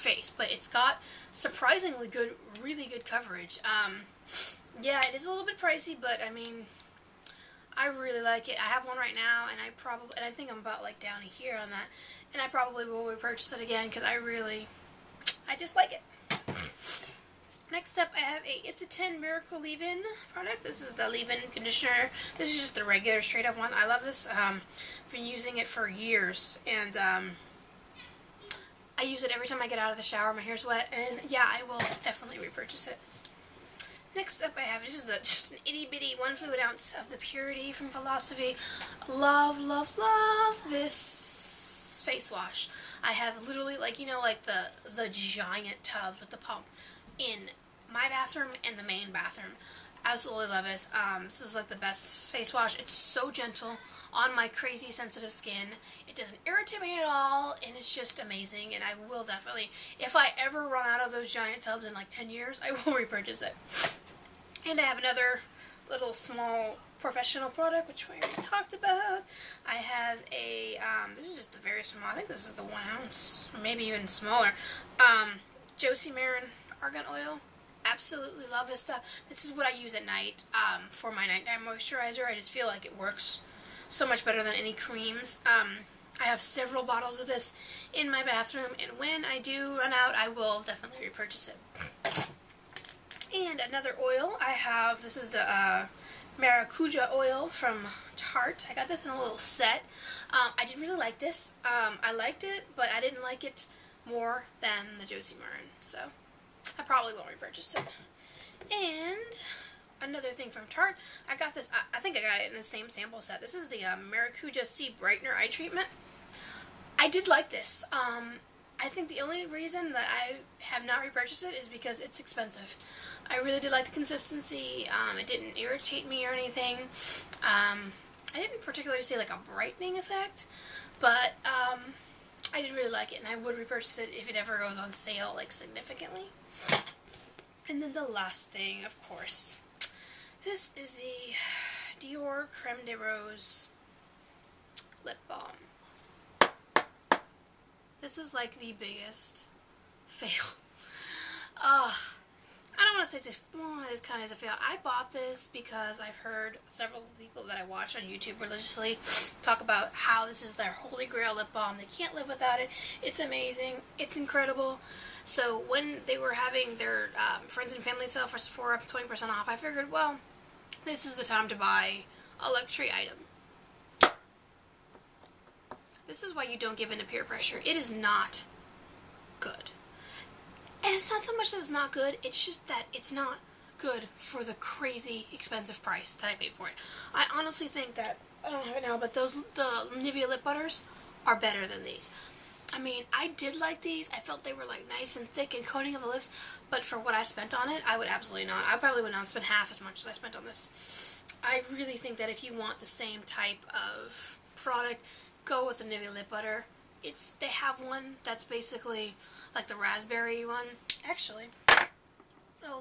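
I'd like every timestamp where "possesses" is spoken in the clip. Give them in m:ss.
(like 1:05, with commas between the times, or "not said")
not said.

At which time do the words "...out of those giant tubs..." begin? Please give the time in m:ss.
1:00.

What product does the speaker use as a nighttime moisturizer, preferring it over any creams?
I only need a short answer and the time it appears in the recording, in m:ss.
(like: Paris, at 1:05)
Josie Maran argan oil, at 1:15.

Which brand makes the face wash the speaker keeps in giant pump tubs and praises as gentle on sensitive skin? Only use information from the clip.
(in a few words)
Philosophy.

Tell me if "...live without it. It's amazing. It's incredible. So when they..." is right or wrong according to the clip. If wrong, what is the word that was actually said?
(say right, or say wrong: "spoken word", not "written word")
right.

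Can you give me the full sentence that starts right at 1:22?
I just feel like it works so much better than any creams.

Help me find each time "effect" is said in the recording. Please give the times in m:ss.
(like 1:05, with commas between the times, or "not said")
2:09.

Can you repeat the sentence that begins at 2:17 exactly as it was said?
And then the last thing, of course, this is the Dior Creme de Rose lip balm.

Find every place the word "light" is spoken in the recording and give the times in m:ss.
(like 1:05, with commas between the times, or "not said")
not said.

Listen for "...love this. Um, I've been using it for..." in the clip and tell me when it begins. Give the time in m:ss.
0:23.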